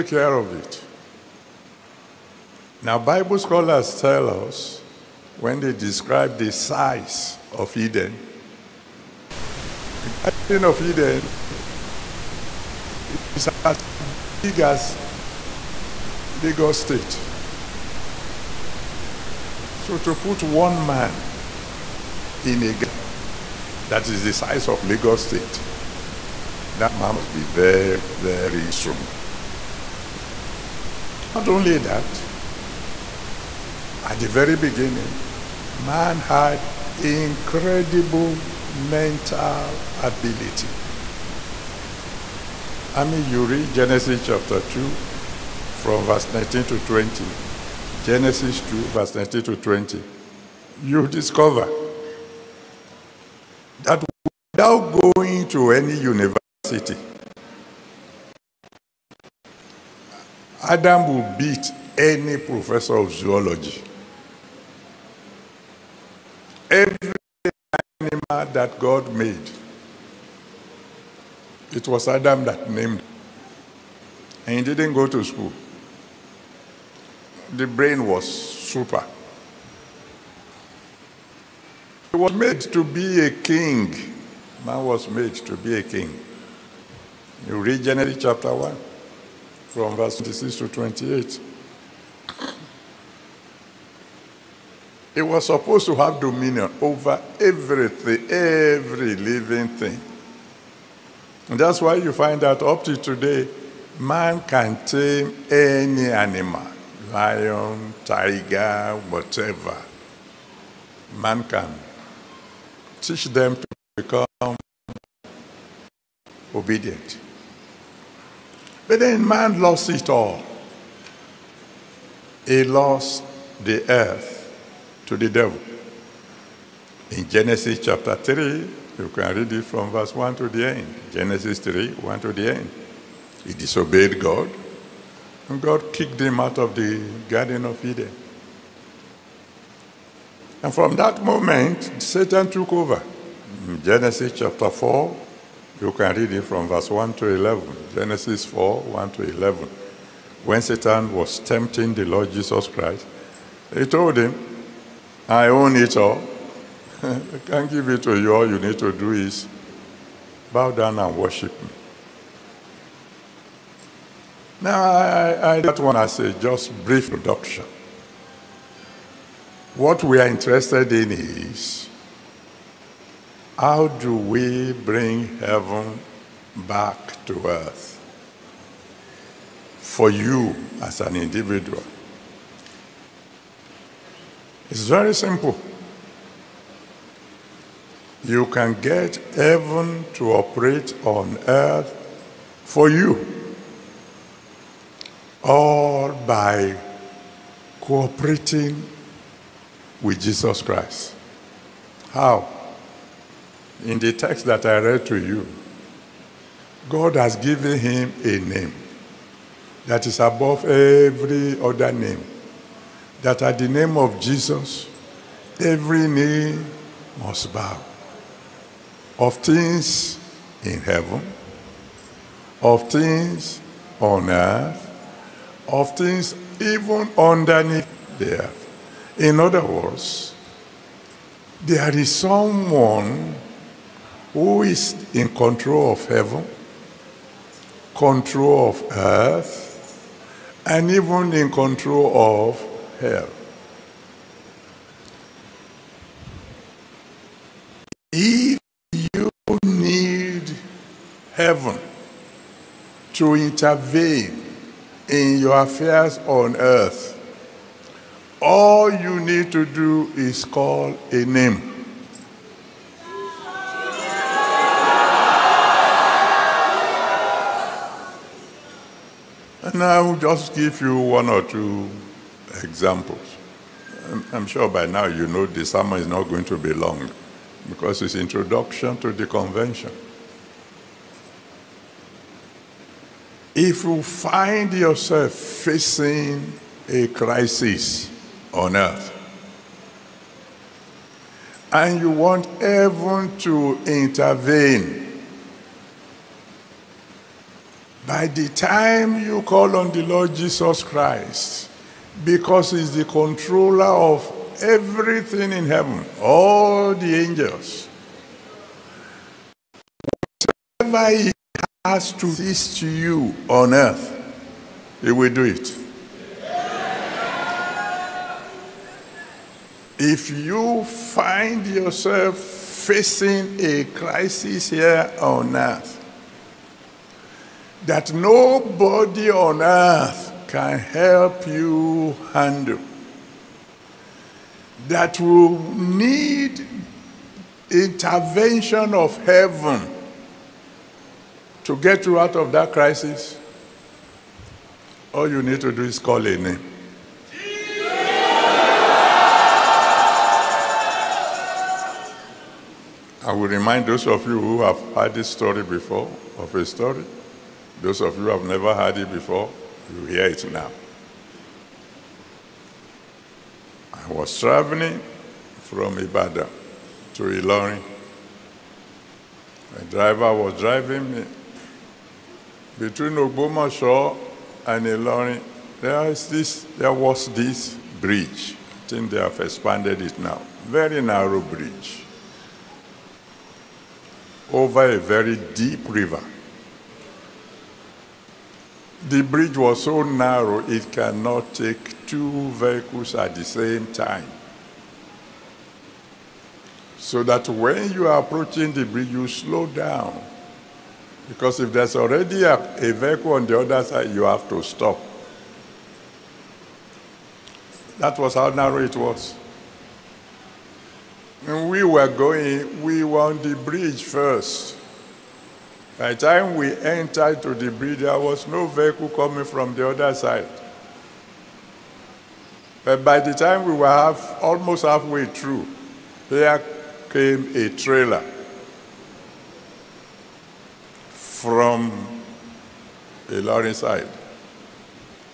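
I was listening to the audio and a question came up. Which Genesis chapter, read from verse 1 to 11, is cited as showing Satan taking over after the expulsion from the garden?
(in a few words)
Genesis 4.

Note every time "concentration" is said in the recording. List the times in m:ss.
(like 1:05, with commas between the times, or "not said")
not said.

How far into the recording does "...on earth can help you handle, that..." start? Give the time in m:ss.
5:29.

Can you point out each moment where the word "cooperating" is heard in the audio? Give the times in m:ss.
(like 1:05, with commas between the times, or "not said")
3:17.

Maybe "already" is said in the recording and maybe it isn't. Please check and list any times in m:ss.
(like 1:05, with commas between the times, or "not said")
6:41.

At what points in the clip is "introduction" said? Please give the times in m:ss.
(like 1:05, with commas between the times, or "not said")
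2:47, 4:38.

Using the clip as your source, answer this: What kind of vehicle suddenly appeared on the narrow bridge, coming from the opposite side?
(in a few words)
A trailer.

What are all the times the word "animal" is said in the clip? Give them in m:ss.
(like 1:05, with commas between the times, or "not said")
1:08, 1:46.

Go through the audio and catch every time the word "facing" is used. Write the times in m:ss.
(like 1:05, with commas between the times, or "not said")
4:45, 5:22.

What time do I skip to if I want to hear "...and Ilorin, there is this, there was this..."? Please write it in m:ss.
6:14.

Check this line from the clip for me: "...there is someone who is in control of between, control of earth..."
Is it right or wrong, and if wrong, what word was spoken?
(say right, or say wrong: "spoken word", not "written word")
wrong: "heaven", not "between".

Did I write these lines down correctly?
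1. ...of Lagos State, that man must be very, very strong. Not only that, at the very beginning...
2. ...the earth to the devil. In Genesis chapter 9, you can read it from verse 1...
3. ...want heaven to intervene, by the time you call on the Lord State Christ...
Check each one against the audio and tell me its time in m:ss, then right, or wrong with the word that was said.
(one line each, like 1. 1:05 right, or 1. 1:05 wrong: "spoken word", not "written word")
1. 0:24 right
2. 2:03 wrong: "3", not "9"
3. 4:52 wrong: "Jesus", not "State".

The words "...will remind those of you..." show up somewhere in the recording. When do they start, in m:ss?
5:53.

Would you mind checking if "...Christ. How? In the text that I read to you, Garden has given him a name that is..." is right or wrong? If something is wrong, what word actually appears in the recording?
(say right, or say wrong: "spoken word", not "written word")
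wrong: "God", not "Garden".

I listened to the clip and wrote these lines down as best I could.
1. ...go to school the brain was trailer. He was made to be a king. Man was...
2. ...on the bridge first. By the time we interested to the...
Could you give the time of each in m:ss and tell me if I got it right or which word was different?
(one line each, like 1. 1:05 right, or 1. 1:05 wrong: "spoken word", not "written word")
1. 1:14 wrong: "super", not "trailer"
2. 6:53 wrong: "entered", not "interested".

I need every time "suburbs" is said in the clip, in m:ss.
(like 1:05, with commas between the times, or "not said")
not said.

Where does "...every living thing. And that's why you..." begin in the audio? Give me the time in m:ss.
1:38.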